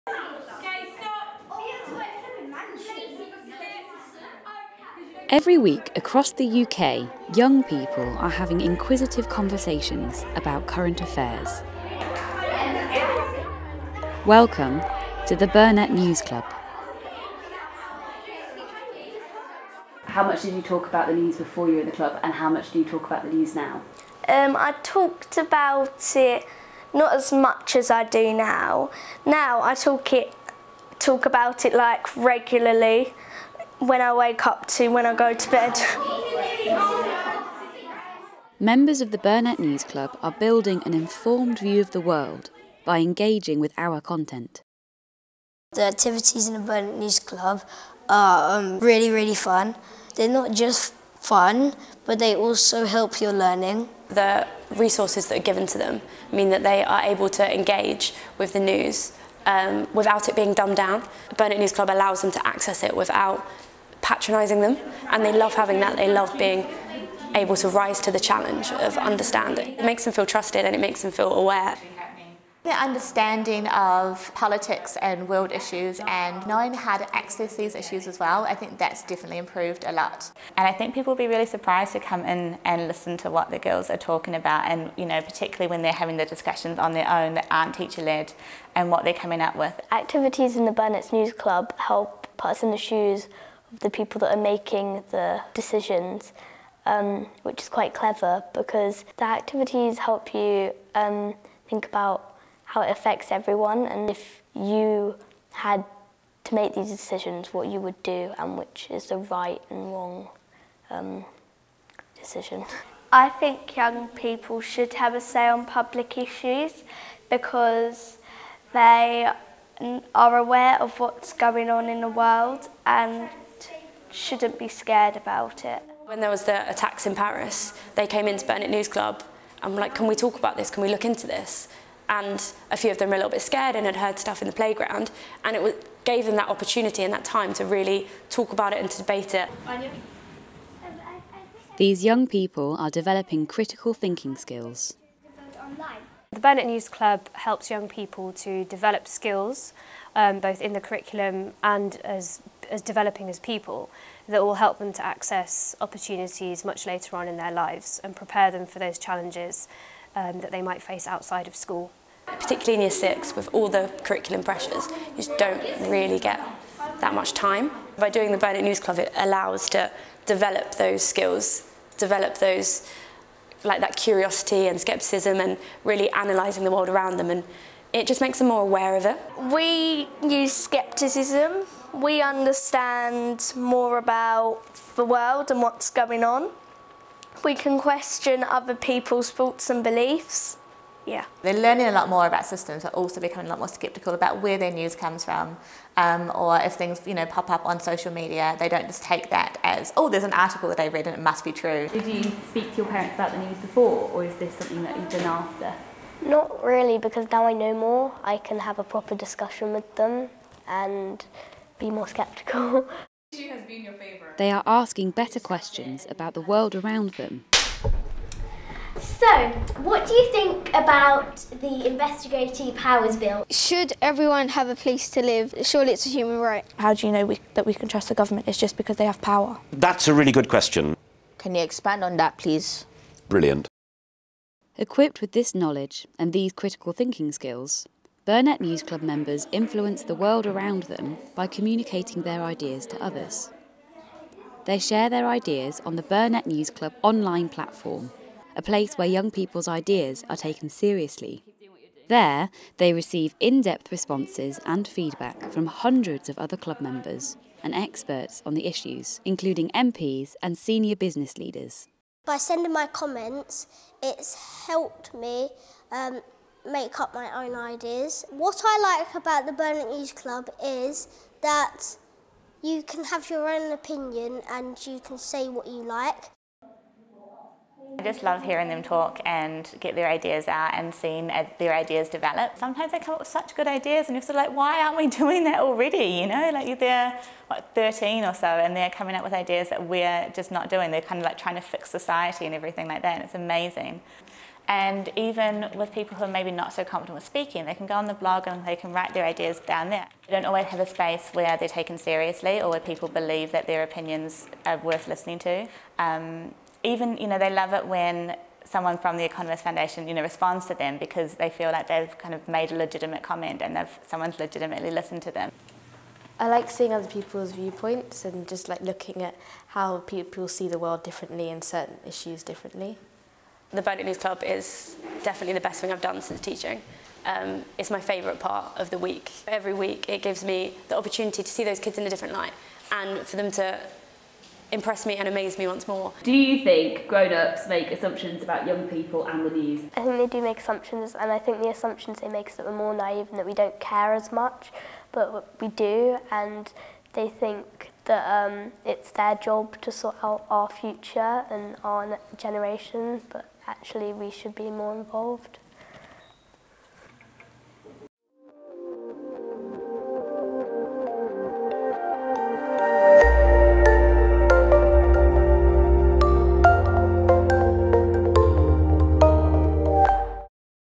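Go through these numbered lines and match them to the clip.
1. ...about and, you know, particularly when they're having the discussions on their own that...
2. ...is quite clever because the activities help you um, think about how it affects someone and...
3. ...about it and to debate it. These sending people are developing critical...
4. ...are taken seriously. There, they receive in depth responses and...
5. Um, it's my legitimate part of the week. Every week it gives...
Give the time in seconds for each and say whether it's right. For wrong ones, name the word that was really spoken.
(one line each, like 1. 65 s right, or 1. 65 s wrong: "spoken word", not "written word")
1. 84 s right
2. 97 s wrong: "everyone", not "someone"
3. 138 s wrong: "young", not "sending"
4. 250 s right
5. 327 s wrong: "favourite", not "legitimate".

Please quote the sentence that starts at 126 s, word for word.
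When there was the attacks in Paris, they came into Burnet News Club and were like, can we talk about this?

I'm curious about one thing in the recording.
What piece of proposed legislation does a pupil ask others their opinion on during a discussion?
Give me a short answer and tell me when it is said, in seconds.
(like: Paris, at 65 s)
Investigative Powers Bill, at 221 s.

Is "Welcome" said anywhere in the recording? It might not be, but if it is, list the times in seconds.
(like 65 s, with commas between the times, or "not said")
14 s.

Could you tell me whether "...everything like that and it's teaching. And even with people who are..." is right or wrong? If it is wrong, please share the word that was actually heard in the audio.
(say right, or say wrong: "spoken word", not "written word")
wrong: "amazing", not "teaching".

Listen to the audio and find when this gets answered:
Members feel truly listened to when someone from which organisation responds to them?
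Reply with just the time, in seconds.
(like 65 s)
309 s.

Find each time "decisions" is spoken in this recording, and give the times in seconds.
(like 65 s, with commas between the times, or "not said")
95 s, 106 s, 112 s.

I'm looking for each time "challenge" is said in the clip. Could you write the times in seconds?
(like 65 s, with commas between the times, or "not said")
68 s, 158 s.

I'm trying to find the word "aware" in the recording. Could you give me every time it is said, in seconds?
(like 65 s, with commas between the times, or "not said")
71 s, 120 s, 178 s.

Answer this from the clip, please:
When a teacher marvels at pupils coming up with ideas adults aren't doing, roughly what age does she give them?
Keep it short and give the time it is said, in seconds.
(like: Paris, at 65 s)
13, at 287 s.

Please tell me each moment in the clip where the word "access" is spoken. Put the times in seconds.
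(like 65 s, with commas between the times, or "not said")
62 s, 77 s, 155 s.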